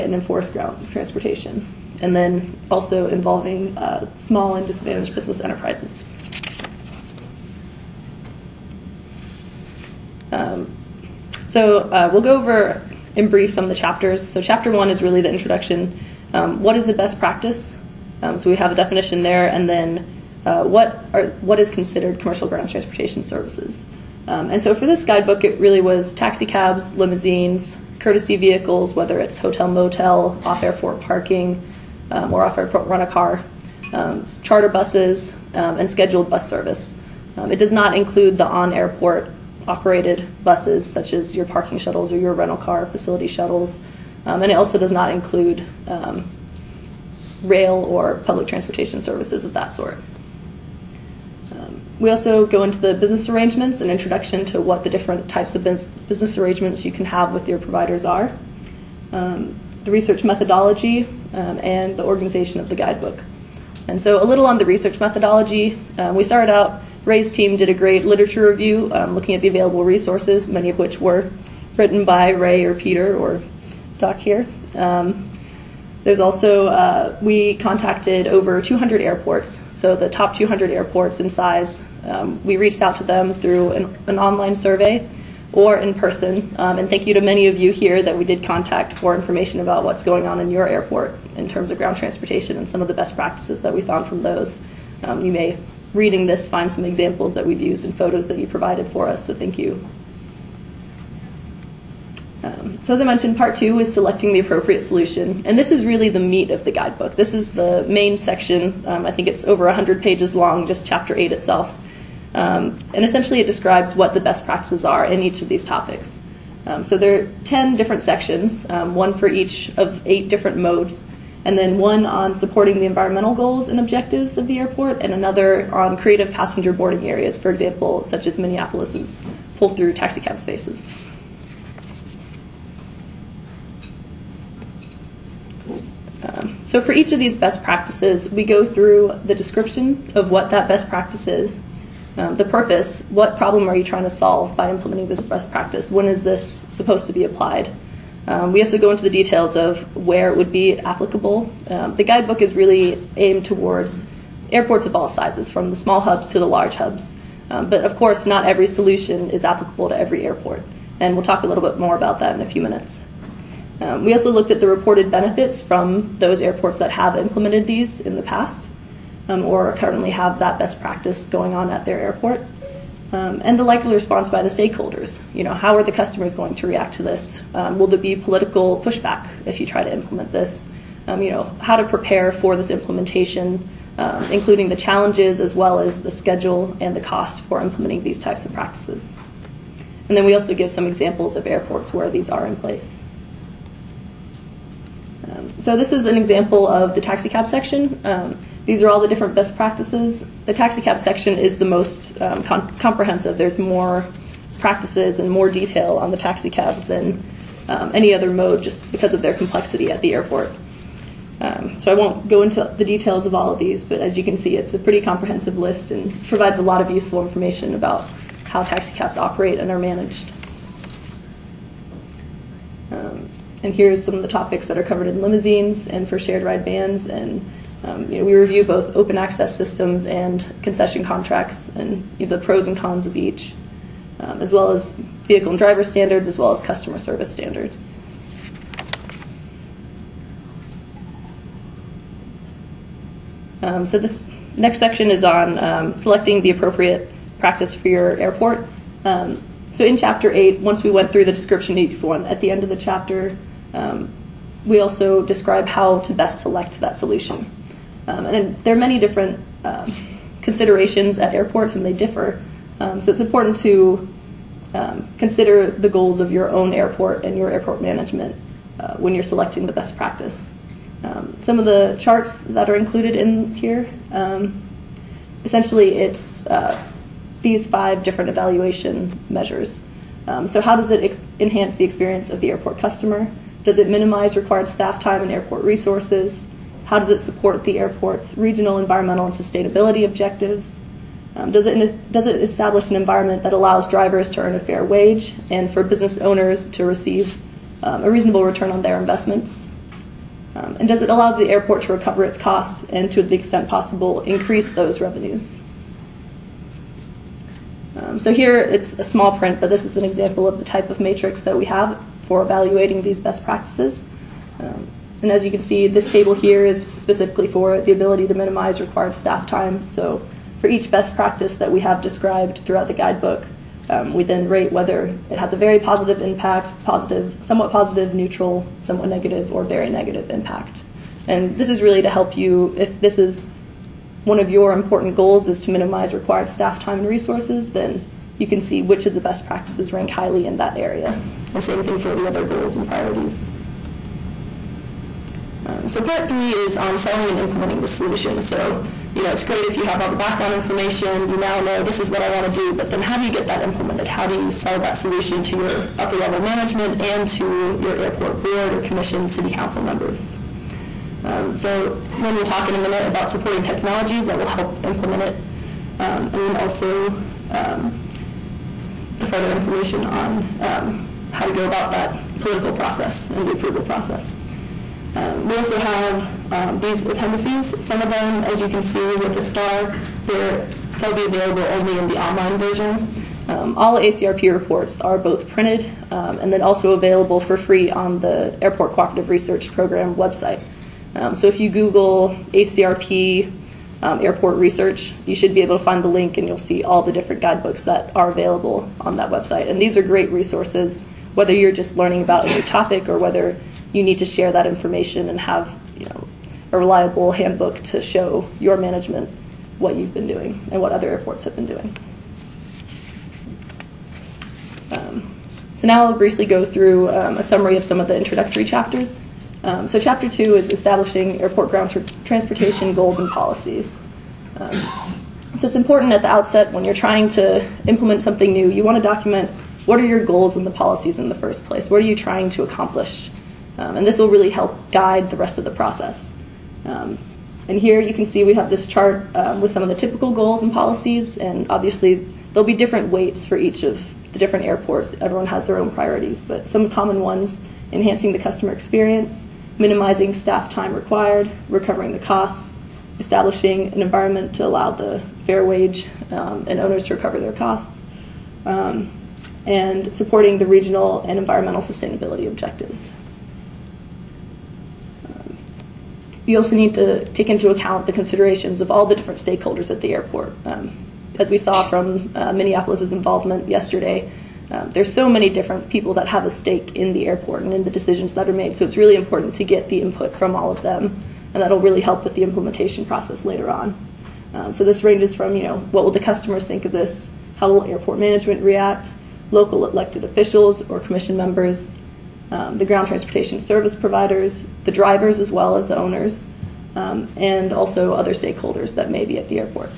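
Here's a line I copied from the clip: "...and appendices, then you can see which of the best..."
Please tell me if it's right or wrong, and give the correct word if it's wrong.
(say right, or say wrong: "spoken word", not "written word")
wrong: "resources", not "appendices".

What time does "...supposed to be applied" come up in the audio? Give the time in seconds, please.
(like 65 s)
146 s.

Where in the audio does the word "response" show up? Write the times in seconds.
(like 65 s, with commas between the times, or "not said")
173 s.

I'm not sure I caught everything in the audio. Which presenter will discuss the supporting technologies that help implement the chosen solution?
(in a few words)
Lynn.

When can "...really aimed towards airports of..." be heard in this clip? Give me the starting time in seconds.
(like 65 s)
152 s.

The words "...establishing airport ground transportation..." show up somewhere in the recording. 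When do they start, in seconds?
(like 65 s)
420 s.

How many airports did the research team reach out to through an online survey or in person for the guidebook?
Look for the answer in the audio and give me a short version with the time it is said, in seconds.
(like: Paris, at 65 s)
200, at 78 s.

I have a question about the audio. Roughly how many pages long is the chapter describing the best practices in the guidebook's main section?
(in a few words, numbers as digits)
over 100.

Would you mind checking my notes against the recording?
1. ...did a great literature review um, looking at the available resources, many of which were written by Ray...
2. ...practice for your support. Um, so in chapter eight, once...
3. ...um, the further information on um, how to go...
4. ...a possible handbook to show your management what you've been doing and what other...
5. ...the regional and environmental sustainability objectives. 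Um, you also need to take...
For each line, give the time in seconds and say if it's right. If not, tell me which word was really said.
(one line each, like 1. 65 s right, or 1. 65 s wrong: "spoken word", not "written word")
1. 67 s right
2. 247 s wrong: "airport", not "support"
3. 367 s right
4. 406 s wrong: "reliable", not "possible"
5. 460 s right.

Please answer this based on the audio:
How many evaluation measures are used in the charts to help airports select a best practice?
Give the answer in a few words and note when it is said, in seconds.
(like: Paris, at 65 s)
5, at 277 s.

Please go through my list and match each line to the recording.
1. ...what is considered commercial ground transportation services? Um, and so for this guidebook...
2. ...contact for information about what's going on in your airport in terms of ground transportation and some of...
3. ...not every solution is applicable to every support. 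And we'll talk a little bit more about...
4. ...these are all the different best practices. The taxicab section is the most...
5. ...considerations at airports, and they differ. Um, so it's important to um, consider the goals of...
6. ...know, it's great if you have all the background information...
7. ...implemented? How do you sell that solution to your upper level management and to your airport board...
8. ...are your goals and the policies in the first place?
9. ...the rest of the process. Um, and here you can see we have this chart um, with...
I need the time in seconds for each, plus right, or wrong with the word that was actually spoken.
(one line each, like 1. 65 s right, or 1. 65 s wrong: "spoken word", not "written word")
1. 21 s right
2. 88 s right
3. 158 s wrong: "airport", not "support"
4. 198 s right
5. 260 s right
6. 349 s right
7. 353 s right
8. 429 s right
9. 435 s right.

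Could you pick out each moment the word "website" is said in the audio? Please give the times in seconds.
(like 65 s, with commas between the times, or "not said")
390 s, 399 s.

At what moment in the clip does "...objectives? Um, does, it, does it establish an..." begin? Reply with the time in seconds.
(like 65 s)
290 s.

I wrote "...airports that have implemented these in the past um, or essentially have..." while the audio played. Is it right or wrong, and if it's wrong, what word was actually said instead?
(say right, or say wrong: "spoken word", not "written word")
wrong: "currently", not "essentially".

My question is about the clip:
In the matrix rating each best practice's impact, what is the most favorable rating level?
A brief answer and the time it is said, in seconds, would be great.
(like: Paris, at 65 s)
very positive, at 325 s.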